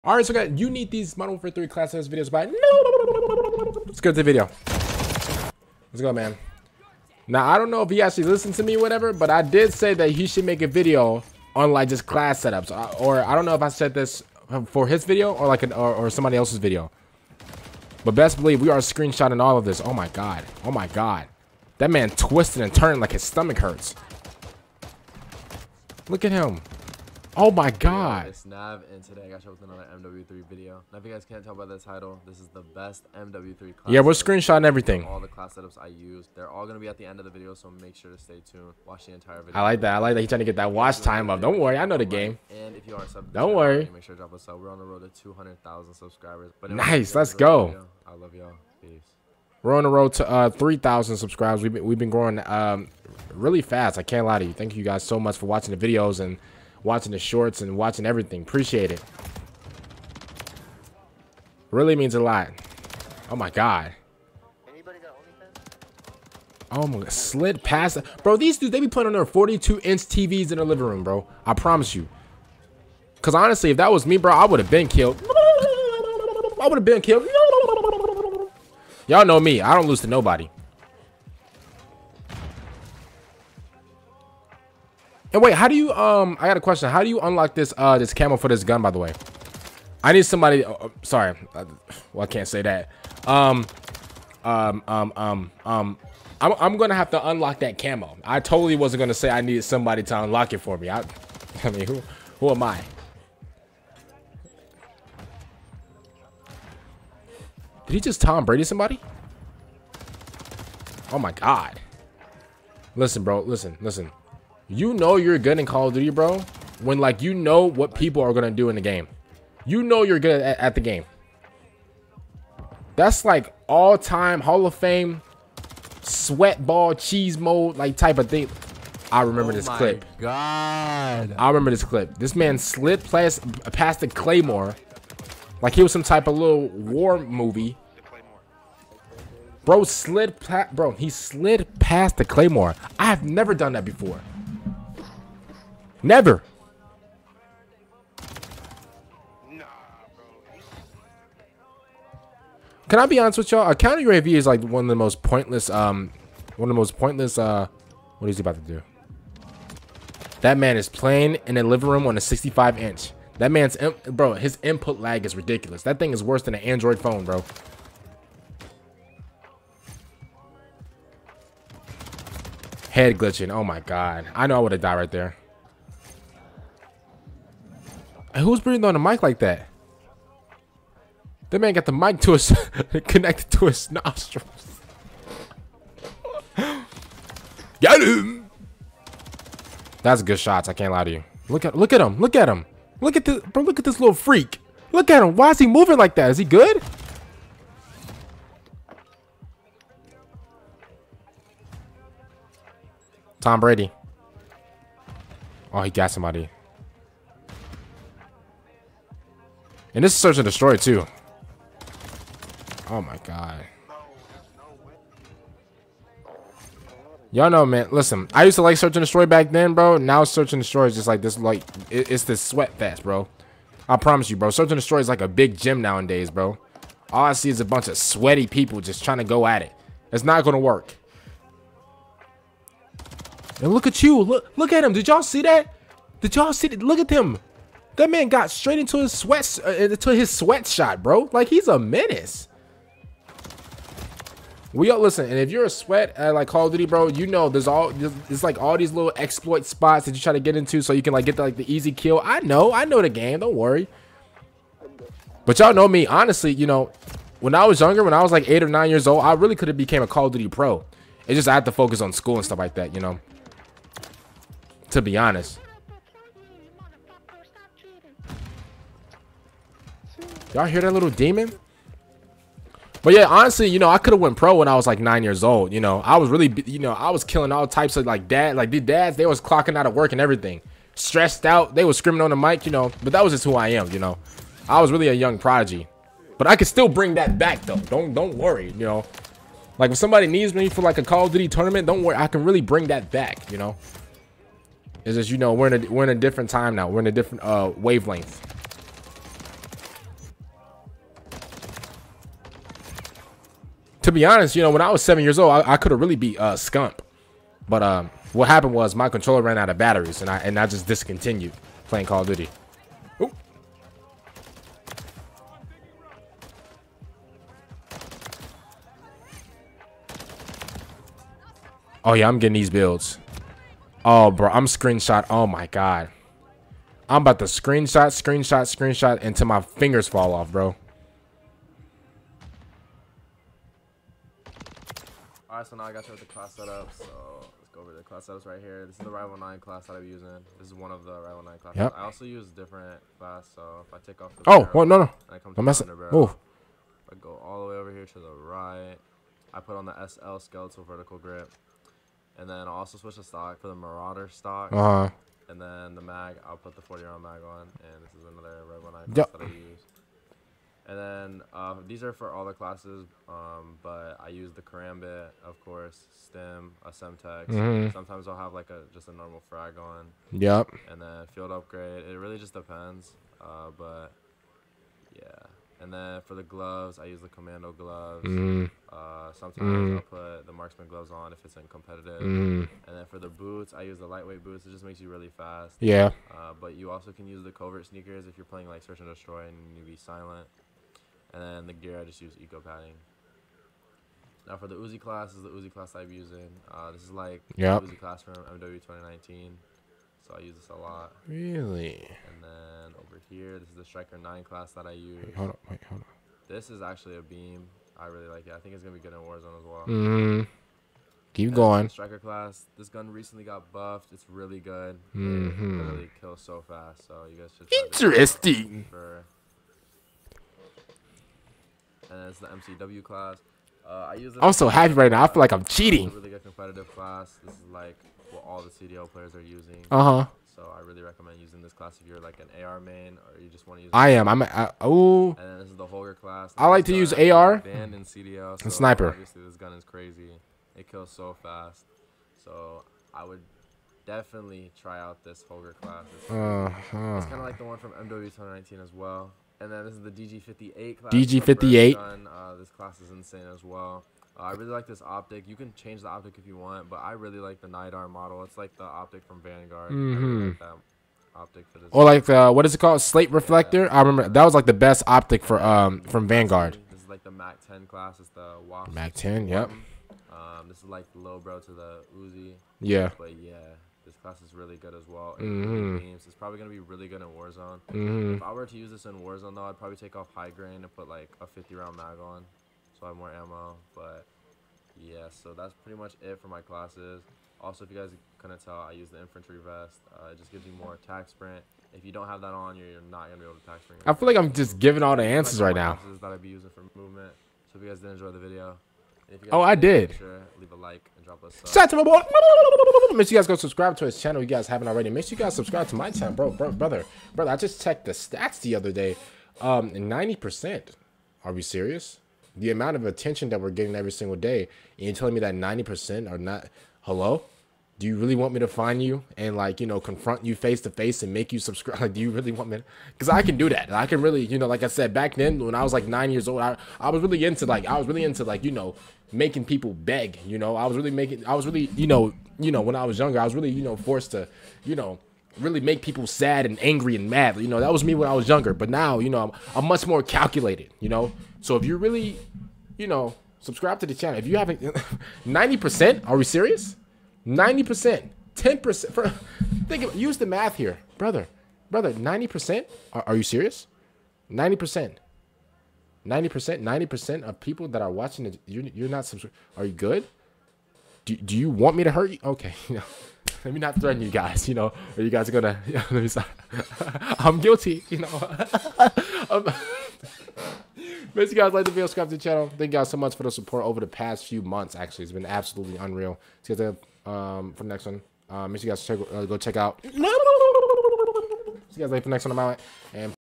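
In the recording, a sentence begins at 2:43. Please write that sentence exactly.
That man's, bro, his input lag is ridiculous.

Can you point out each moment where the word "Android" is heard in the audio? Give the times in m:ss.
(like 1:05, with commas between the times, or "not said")
2:46.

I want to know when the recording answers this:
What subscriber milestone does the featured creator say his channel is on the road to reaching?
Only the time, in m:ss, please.
0:45.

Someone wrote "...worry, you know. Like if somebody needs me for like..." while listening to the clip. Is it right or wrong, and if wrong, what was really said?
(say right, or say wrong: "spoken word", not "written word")
right.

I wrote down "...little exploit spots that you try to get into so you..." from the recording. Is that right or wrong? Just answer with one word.
right.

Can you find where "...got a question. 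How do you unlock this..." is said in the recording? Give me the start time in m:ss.
1:26.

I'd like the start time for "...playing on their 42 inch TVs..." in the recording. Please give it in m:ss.
1:08.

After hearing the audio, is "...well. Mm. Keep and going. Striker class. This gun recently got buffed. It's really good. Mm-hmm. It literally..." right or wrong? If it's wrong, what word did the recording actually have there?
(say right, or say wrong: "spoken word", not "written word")
right.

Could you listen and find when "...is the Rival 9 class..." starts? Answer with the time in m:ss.
5:38.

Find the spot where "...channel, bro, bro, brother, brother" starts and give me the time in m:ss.
8:26.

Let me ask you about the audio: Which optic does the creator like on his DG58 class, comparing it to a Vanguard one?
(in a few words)
Nydar model.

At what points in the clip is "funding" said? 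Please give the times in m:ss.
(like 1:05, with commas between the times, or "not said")
not said.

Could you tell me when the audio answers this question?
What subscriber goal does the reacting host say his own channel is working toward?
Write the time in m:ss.
0:50.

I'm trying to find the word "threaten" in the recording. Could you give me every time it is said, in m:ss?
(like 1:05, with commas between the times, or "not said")
9:23.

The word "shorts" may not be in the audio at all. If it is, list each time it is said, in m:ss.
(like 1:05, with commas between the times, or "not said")
0:57.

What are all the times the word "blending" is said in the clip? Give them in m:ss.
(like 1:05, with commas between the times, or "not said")
not said.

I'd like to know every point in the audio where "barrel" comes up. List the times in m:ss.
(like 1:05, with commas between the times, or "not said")
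5:44.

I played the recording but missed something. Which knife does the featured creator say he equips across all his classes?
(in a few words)
Karambit.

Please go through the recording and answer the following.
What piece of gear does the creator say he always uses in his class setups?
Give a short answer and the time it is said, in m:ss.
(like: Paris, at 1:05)
EOD padding, at 6:32.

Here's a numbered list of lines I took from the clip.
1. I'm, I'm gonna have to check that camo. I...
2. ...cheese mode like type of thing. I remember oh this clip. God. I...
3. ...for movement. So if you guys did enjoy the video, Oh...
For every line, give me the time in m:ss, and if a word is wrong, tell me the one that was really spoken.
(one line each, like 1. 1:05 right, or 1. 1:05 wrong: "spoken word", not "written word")
1. 1:36 wrong: "unlock", not "check"
2. 2:06 right
3. 8:16 right.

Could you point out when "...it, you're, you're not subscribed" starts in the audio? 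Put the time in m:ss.
9:18.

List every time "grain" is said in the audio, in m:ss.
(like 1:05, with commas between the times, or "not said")
8:00.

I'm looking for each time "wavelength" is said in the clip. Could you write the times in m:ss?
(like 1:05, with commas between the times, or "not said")
4:57.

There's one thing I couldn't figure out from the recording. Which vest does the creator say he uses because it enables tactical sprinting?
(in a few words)
Infantry vest.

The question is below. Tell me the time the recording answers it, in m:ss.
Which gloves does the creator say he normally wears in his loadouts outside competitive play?
6:17.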